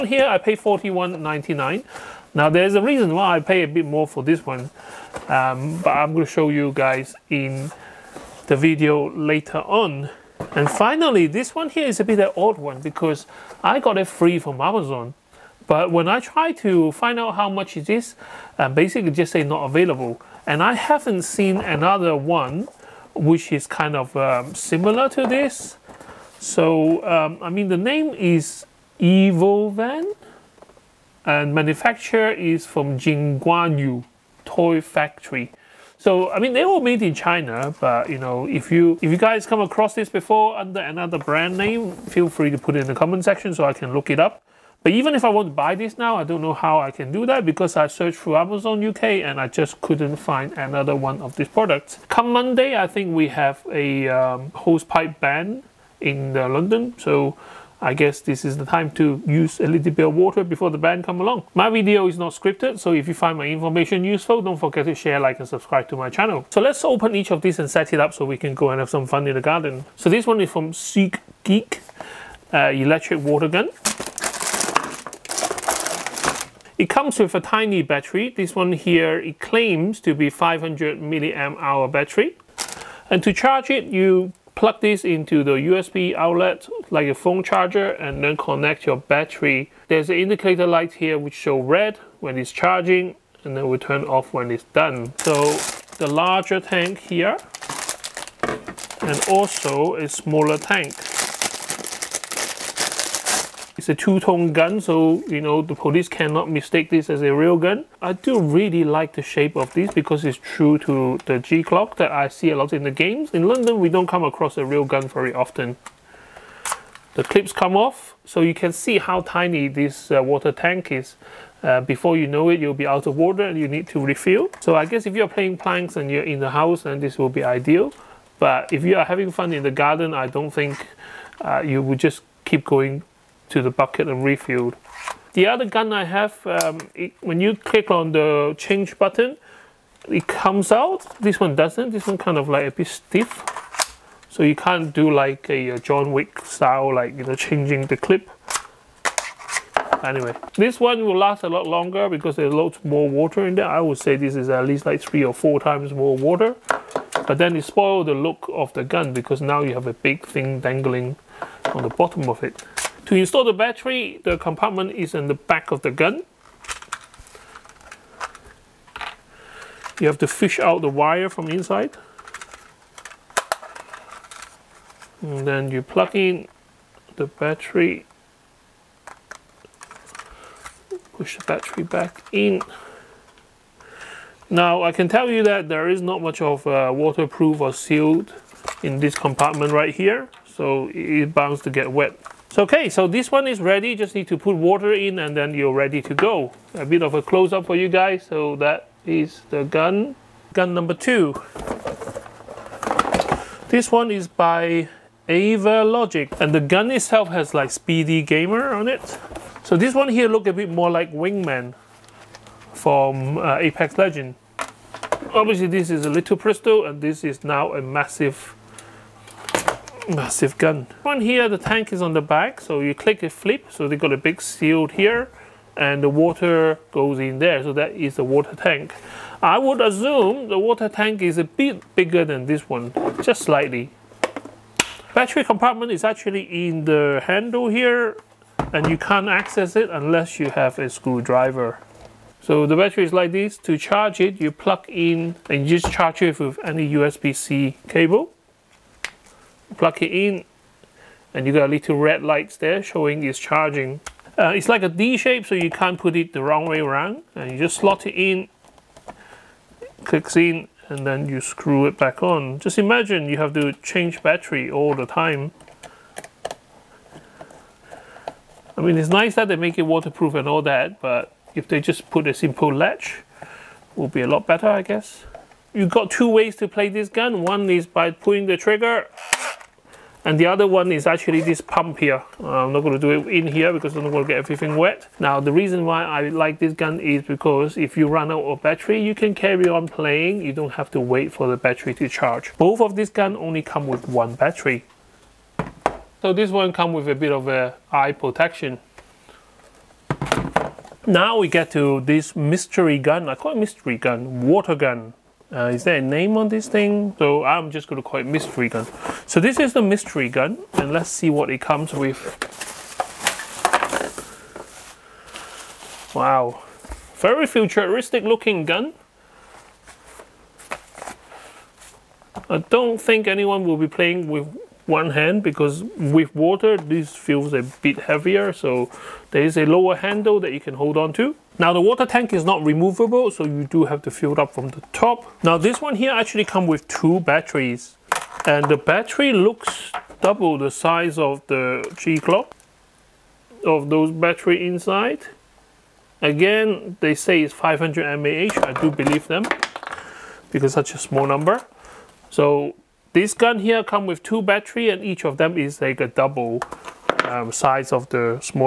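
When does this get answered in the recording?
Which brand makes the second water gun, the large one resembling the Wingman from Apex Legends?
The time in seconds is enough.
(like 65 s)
205 s.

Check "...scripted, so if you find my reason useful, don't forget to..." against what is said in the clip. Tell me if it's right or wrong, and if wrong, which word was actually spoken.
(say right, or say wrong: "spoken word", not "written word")
wrong: "information", not "reason".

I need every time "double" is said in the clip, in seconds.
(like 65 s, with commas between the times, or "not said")
340 s, 356 s.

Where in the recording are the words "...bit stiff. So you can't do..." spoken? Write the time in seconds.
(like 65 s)
142 s.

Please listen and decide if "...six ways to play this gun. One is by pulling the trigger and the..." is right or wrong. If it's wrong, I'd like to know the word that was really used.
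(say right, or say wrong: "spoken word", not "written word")
wrong: "two", not "six".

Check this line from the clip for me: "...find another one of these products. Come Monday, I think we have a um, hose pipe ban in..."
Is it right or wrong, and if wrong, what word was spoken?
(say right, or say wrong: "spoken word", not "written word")
right.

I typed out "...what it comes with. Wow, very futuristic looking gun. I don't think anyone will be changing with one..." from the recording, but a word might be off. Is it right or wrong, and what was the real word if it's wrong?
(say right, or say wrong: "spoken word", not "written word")
wrong: "playing", not "changing".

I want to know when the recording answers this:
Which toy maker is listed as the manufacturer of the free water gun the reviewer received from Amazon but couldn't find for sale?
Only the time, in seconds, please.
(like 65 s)
32 s.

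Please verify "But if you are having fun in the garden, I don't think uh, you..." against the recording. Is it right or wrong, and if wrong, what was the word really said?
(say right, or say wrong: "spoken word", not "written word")
right.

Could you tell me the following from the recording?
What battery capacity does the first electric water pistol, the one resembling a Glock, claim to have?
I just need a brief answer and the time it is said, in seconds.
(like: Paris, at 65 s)
500 mAh, at 80 s.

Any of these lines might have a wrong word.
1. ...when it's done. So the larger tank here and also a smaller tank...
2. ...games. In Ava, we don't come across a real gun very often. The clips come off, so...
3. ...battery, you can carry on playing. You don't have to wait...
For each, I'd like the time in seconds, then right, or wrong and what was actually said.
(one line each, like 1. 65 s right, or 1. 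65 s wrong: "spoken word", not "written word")
1. 94 s right
2. 112 s wrong: "London", not "Ava"
3. 288 s right.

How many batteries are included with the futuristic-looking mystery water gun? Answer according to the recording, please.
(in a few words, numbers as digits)
2.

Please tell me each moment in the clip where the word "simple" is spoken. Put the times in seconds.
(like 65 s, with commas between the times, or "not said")
272 s.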